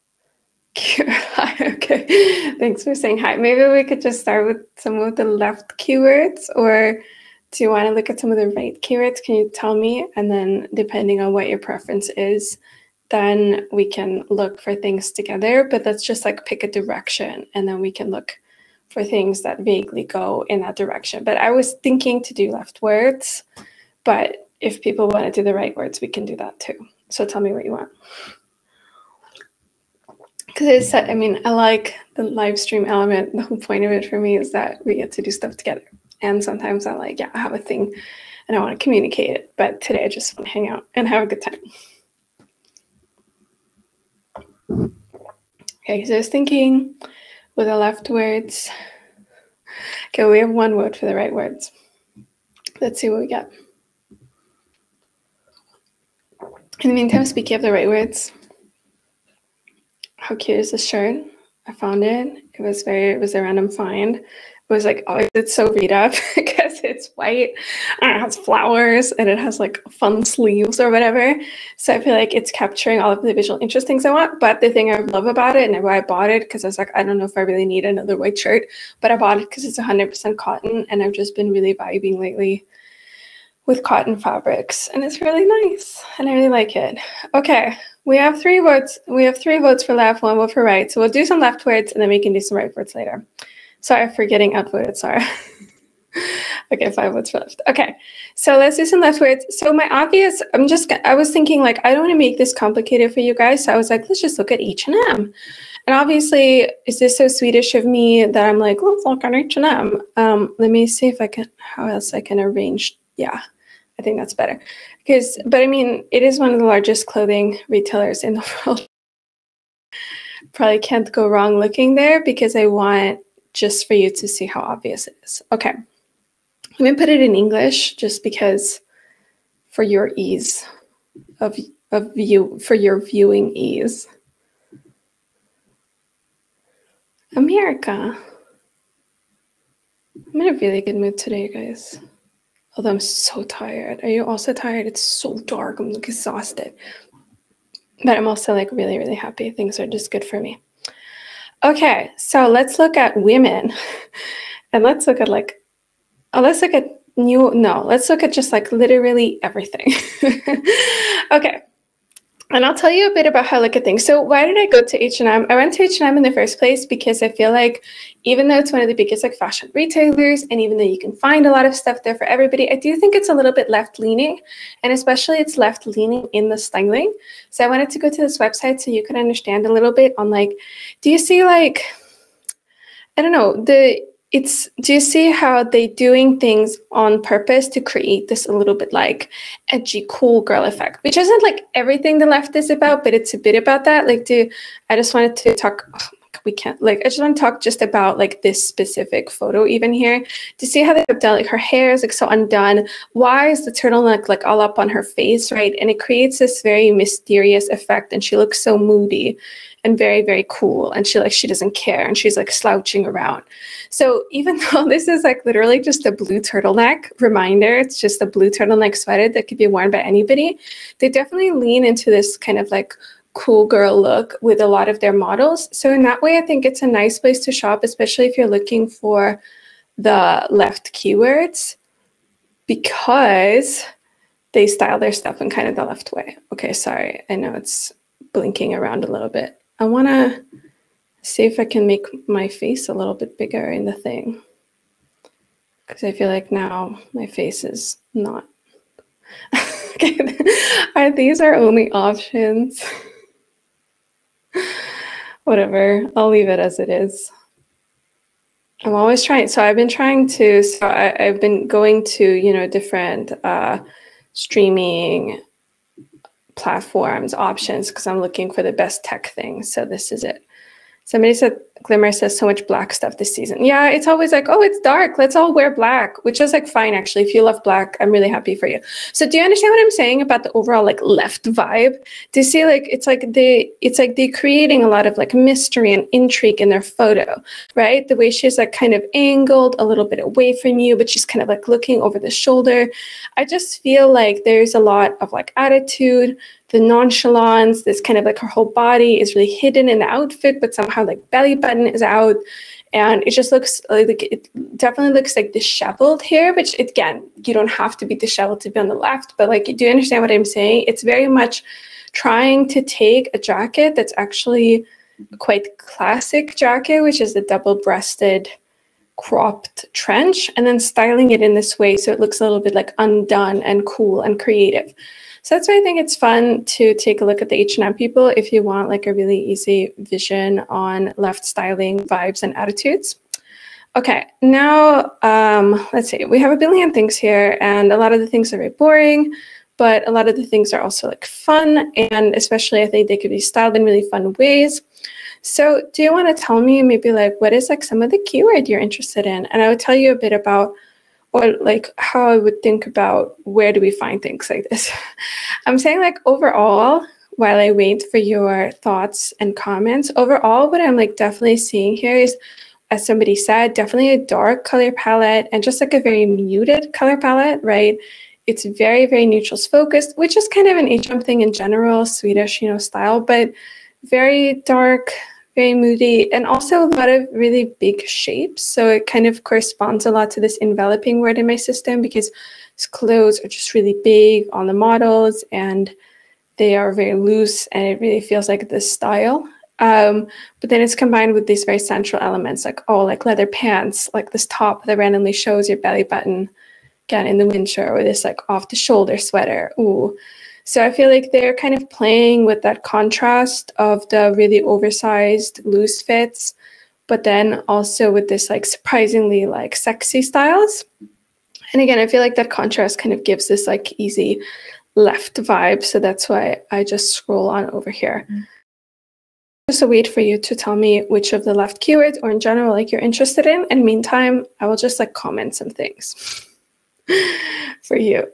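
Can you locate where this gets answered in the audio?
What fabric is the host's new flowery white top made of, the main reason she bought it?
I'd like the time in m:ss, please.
1:19.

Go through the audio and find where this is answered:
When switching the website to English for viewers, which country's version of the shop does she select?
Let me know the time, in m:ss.
2:17.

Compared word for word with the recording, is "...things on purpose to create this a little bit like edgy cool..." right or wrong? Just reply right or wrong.
right.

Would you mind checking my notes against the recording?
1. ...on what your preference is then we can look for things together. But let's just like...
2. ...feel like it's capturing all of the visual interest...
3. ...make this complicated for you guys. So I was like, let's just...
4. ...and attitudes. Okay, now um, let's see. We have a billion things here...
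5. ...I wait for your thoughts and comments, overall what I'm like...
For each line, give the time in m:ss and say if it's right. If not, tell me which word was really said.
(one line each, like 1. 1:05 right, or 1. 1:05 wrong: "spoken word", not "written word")
1. 0:11 right
2. 1:12 right
3. 1:42 right
4. 5:32 right
5. 5:57 right.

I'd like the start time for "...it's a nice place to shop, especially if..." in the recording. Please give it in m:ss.
3:46.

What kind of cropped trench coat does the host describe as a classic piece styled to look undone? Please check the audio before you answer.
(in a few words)
double-breasted.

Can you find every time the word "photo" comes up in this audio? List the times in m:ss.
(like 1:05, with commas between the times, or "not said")
3:19, 4:46.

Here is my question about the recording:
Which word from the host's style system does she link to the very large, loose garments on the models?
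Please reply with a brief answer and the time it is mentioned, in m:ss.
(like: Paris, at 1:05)
enveloping, at 6:20.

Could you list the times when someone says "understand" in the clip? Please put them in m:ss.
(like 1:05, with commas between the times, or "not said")
2:59, 4:39, 5:09.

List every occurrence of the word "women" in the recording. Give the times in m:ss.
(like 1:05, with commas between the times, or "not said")
2:33.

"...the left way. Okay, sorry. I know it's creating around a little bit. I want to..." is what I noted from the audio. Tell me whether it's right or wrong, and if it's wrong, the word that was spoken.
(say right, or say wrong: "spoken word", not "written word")
wrong: "blinking", not "creating".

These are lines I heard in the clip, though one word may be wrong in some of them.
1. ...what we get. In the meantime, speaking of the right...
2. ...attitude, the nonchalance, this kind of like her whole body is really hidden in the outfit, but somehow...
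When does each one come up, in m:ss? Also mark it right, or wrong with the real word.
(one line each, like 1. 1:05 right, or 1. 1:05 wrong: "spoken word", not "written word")
1. 0:53 right
2. 4:55 right.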